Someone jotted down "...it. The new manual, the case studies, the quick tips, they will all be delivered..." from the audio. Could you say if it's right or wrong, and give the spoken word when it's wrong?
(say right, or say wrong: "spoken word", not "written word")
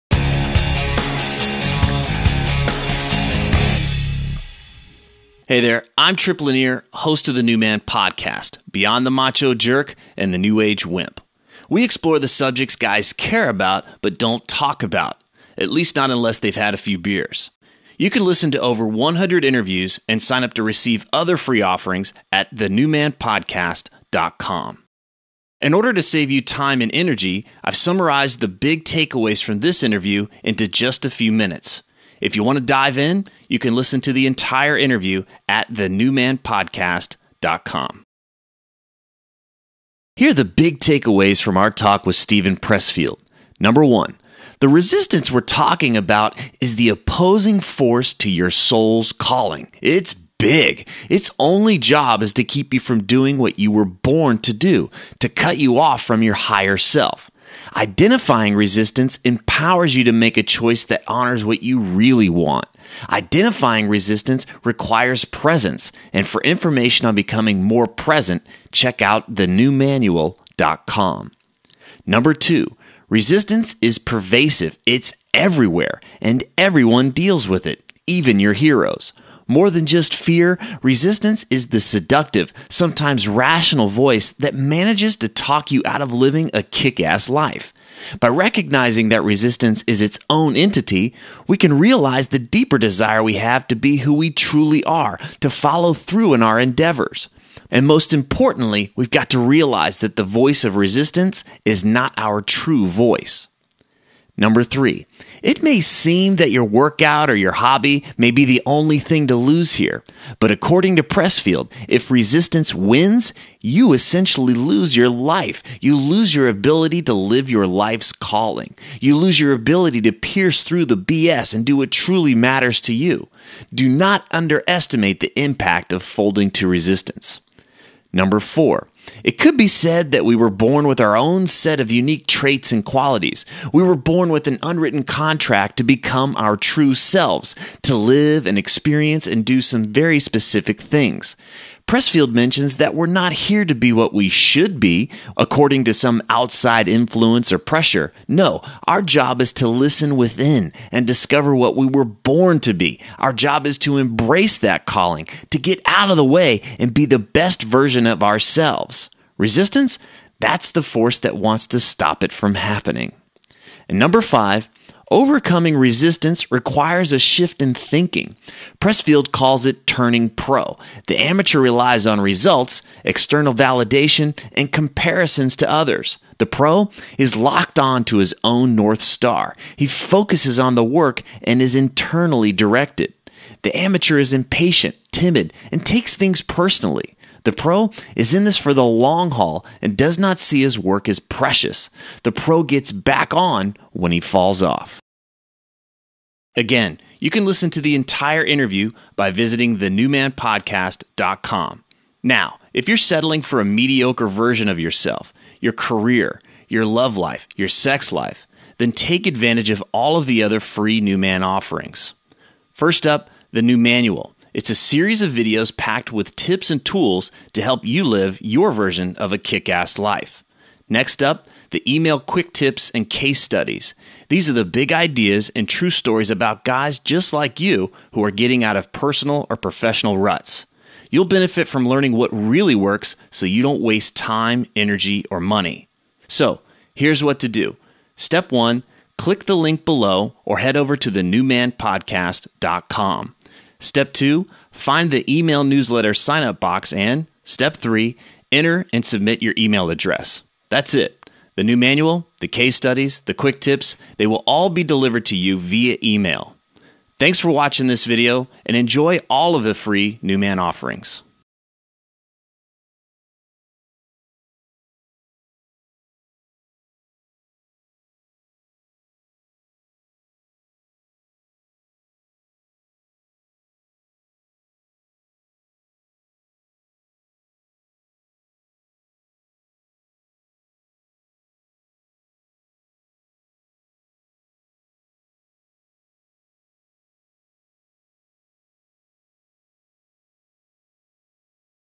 right.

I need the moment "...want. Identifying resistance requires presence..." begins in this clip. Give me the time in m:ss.
1:02.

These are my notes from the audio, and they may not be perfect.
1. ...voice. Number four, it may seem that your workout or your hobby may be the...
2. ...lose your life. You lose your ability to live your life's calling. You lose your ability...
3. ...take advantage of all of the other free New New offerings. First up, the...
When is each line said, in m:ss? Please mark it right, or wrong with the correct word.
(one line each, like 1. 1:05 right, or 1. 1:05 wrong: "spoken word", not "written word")
1. 1:42 wrong: "three", not "four"
2. 1:54 right
3. 3:28 wrong: "Man", not "New".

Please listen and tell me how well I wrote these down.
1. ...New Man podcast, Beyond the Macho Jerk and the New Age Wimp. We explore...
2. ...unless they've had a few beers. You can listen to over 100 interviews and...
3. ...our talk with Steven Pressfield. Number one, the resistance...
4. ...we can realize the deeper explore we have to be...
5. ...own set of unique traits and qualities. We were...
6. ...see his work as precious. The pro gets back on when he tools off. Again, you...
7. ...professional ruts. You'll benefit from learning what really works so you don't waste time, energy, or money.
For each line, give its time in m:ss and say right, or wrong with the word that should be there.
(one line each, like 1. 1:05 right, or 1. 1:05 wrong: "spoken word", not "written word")
1. 0:07 right
2. 0:16 right
3. 0:41 right
4. 1:31 wrong: "desire", not "explore"
5. 2:11 right
6. 3:10 wrong: "falls", not "tools"
7. 3:49 right.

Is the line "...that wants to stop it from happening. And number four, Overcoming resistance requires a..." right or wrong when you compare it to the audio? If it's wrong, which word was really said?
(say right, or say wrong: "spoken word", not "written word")
wrong: "five", not "four".